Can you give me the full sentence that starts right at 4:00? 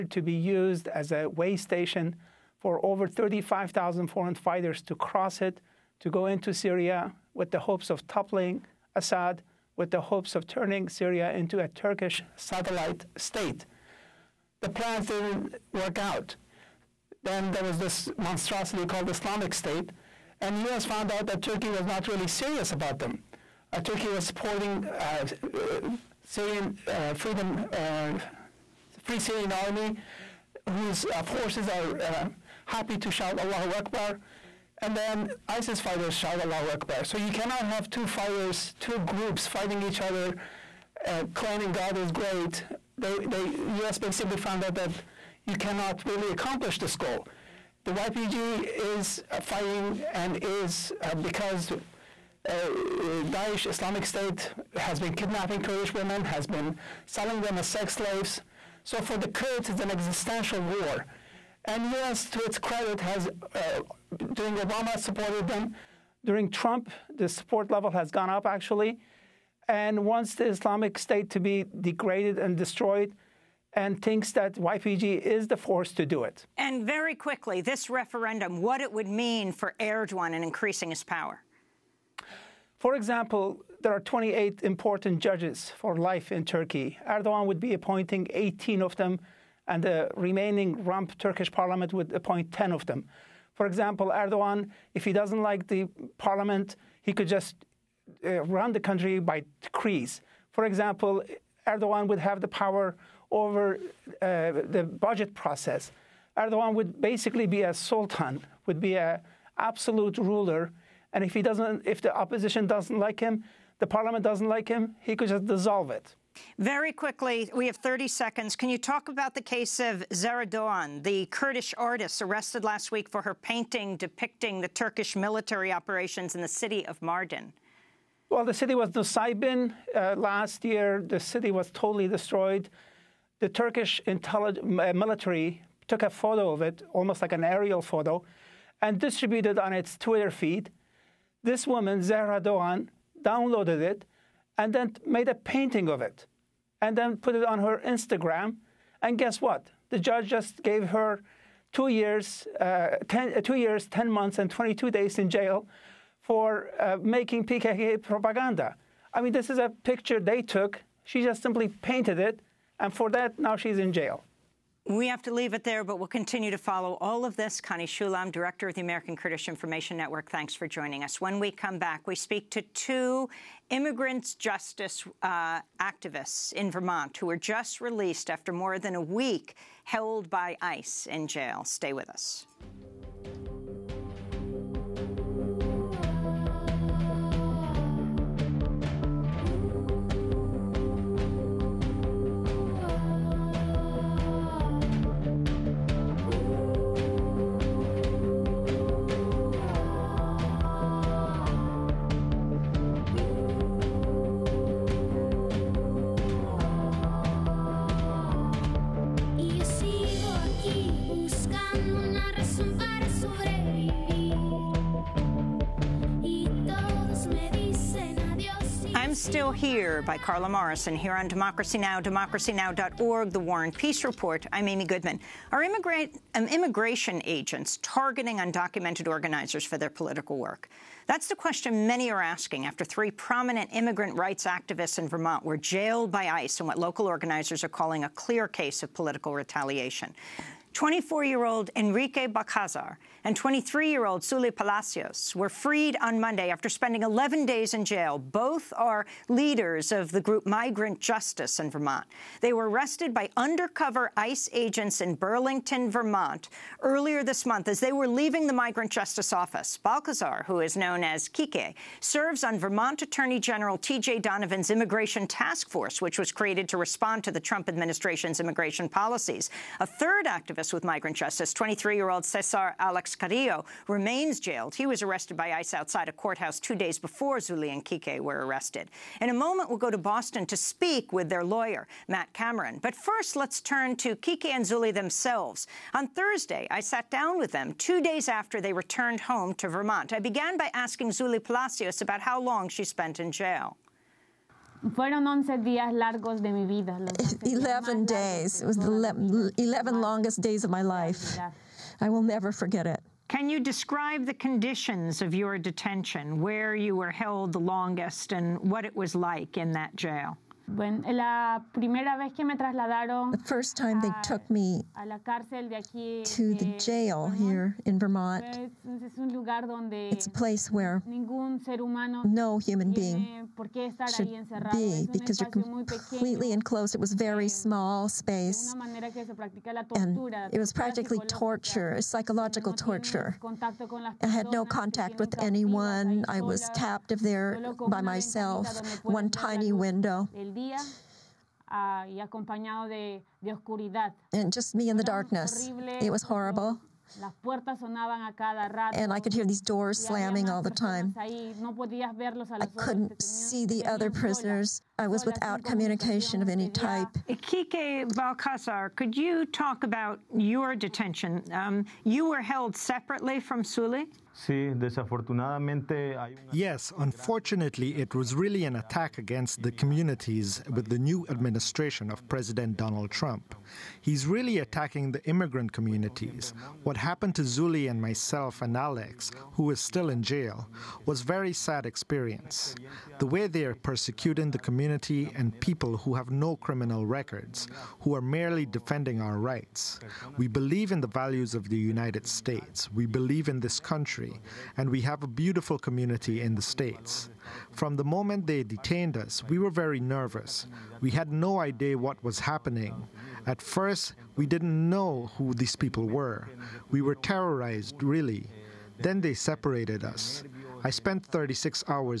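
24 year old Enrique Balcazar and 23 year old Zuli Palacios were freed on Monday after spending 11 days in jail.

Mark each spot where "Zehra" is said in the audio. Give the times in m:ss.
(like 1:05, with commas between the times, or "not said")
2:00, 2:22.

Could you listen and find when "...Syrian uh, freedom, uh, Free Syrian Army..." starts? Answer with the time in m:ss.
0:26.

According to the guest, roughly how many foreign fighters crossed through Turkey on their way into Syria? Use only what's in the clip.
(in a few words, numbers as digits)
35,000.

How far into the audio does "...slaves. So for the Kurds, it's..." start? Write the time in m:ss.
0:57.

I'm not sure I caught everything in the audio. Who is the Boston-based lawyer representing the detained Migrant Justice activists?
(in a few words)
Matt Cameron.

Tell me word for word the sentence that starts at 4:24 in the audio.
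Donovan's Immigration Task Force, which was created to respond to the Trump administration's immigration policies.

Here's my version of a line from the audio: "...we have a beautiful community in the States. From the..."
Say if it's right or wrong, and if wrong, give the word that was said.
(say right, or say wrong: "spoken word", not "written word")
right.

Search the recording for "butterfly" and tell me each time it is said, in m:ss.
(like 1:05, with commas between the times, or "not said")
not said.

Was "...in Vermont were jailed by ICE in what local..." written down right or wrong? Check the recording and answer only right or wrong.
right.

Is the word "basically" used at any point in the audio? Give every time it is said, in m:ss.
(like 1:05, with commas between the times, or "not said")
0:43, 1:47.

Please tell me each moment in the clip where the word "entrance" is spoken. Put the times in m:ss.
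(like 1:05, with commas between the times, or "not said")
not said.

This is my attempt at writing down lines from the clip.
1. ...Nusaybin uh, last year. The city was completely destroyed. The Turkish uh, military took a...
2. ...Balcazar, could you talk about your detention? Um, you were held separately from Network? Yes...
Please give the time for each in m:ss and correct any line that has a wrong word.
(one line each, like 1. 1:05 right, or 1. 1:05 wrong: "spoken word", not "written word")
1. 2:08 wrong: "totally", not "completely"
2. 5:58 wrong: "Suli", not "Network".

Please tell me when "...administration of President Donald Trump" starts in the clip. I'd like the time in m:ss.
6:11.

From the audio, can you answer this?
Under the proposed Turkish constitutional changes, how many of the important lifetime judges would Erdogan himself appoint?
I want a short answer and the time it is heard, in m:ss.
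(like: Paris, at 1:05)
18, at 1:28.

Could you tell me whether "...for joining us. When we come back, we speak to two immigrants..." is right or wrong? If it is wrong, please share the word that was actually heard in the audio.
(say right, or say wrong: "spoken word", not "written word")
right.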